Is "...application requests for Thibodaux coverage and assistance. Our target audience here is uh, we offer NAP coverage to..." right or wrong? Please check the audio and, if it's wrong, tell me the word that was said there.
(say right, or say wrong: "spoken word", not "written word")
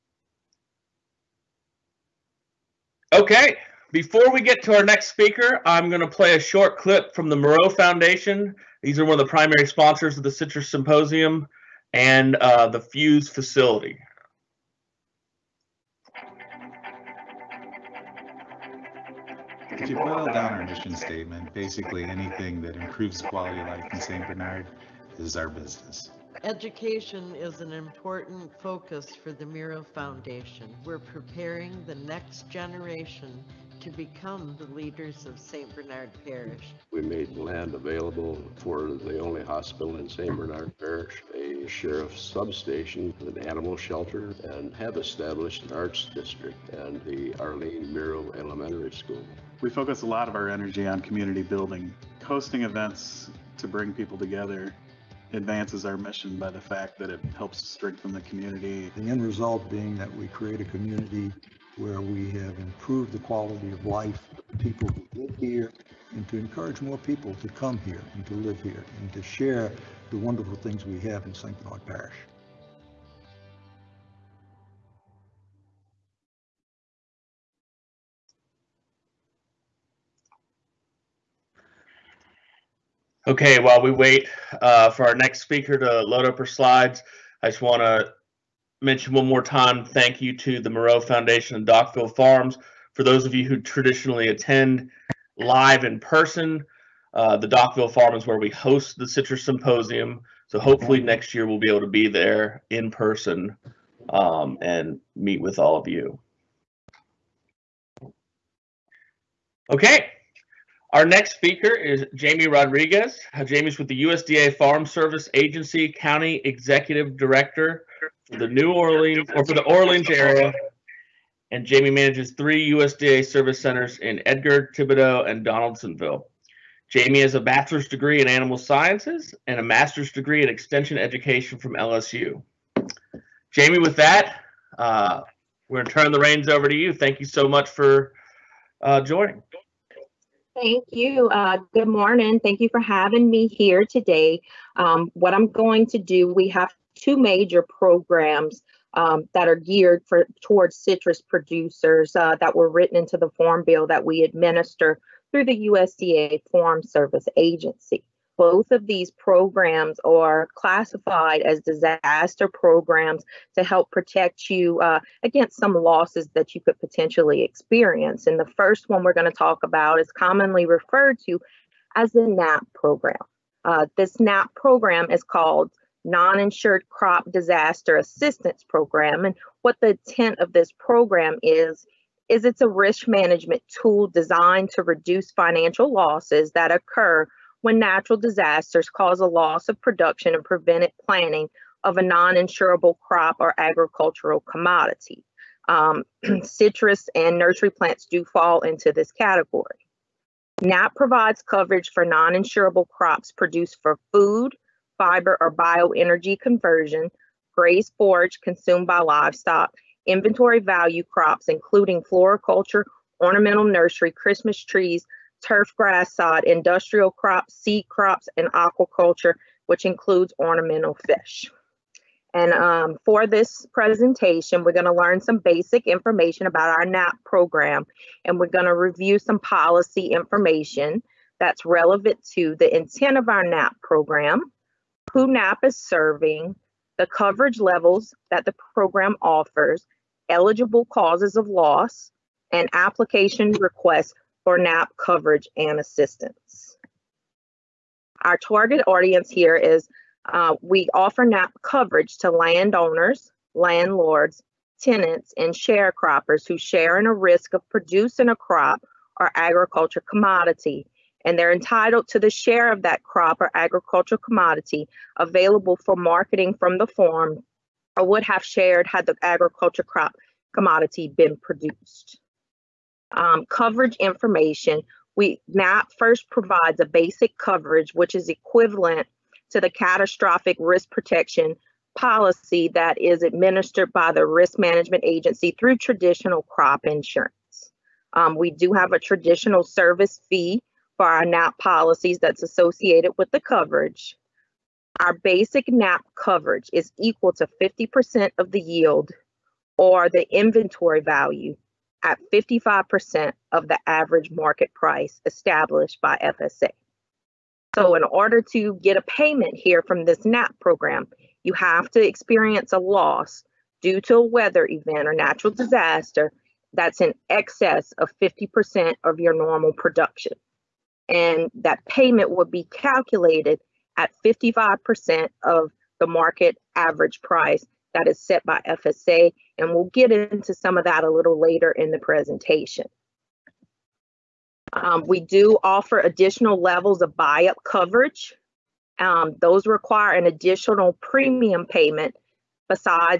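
wrong: "NAP", not "Thibodaux".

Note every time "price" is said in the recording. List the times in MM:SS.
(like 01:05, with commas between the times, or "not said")
05:04, 05:27.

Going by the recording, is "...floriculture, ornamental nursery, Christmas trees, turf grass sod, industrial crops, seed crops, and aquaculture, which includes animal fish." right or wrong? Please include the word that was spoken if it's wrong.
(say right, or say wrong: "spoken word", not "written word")
wrong: "ornamental", not "animal".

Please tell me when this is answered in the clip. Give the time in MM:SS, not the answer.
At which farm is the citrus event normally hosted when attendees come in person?
01:37.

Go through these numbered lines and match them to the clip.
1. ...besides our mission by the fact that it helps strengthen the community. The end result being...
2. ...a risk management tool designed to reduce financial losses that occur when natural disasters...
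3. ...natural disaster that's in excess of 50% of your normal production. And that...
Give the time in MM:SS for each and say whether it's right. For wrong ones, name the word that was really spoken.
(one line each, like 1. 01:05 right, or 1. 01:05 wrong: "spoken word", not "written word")
1. 00:55 wrong: "advances", not "besides"
2. 03:02 right
3. 05:15 right.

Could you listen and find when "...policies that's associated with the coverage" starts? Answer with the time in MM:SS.
04:51.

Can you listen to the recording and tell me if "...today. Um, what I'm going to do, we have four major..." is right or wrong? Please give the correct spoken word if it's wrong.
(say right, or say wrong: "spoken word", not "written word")
wrong: "two", not "four".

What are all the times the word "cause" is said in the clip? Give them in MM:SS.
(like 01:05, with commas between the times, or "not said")
03:08, 04:00.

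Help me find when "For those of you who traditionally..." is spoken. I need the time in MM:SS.
01:32.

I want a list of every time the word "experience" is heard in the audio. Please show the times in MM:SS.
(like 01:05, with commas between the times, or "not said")
02:47, 05:12.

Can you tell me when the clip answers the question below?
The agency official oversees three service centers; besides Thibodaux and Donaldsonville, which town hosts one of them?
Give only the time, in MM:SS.
02:04.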